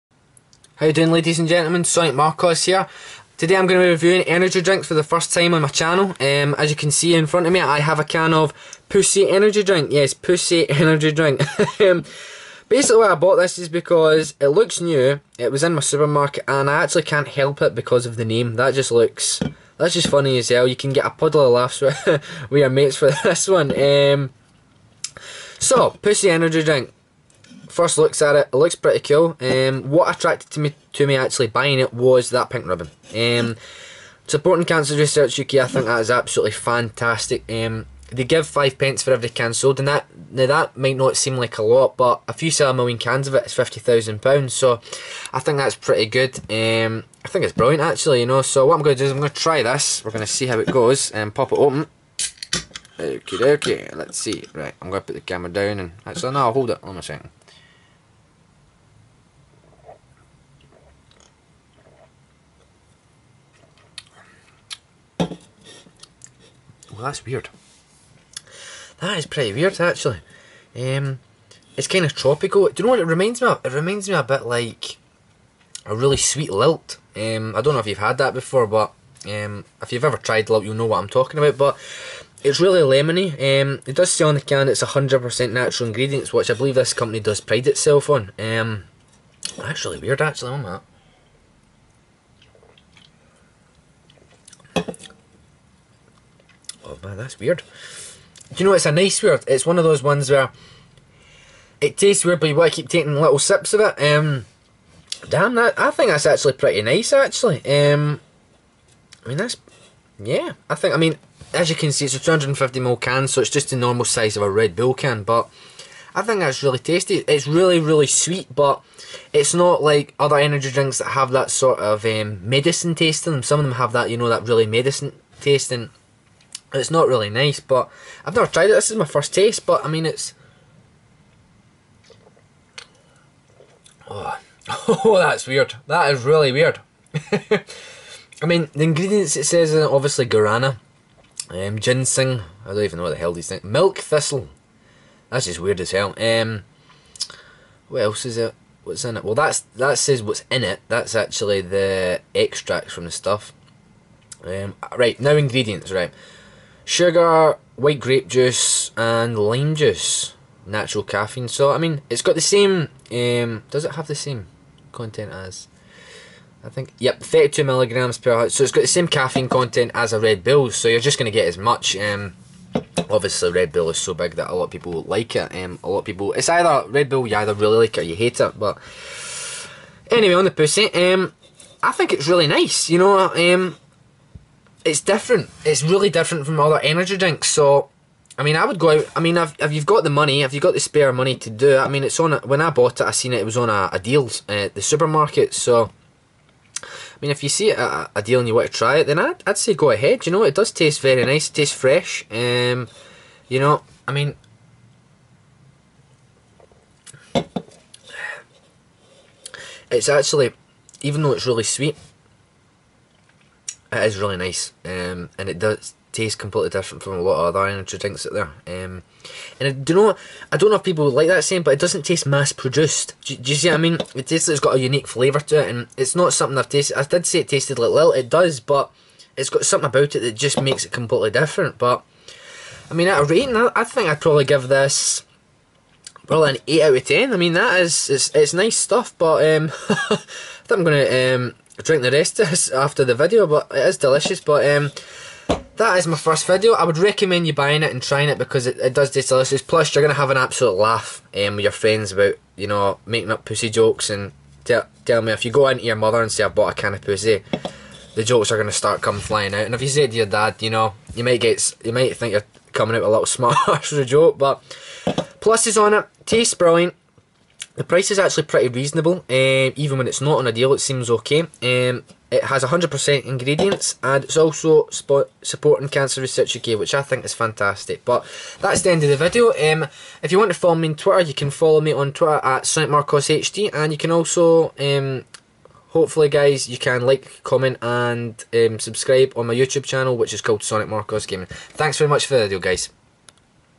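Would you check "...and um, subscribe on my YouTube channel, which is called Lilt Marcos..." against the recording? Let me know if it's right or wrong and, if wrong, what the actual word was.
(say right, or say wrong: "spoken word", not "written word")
wrong: "Sonic", not "Lilt".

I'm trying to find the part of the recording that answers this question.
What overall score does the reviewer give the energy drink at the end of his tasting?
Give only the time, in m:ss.
3:56.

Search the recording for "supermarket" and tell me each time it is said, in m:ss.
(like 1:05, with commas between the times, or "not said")
0:15, 3:14.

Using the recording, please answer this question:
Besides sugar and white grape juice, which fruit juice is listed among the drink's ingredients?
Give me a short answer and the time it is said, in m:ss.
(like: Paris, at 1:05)
Lime juice, at 2:39.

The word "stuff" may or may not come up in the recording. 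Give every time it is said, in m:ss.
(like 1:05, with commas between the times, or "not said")
2:33, 3:58.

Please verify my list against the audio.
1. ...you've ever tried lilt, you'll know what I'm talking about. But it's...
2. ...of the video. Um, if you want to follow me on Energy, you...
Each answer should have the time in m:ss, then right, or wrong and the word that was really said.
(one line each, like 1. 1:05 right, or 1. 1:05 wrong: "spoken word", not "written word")
1. 1:19 right
2. 4:39 wrong: "Twitter", not "Energy".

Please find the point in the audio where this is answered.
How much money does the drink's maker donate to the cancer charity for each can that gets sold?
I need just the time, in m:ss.
0:38.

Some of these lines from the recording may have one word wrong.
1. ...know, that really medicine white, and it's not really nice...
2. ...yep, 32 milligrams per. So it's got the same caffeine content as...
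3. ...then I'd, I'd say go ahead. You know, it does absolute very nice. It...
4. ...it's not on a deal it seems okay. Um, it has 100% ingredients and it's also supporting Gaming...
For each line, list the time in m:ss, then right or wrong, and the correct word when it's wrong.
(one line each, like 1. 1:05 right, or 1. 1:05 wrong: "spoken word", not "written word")
1. 2:04 wrong: "taste", not "white"
2. 2:46 right
3. 3:19 wrong: "taste", not "absolute"
4. 4:30 wrong: "Cancer", not "Gaming".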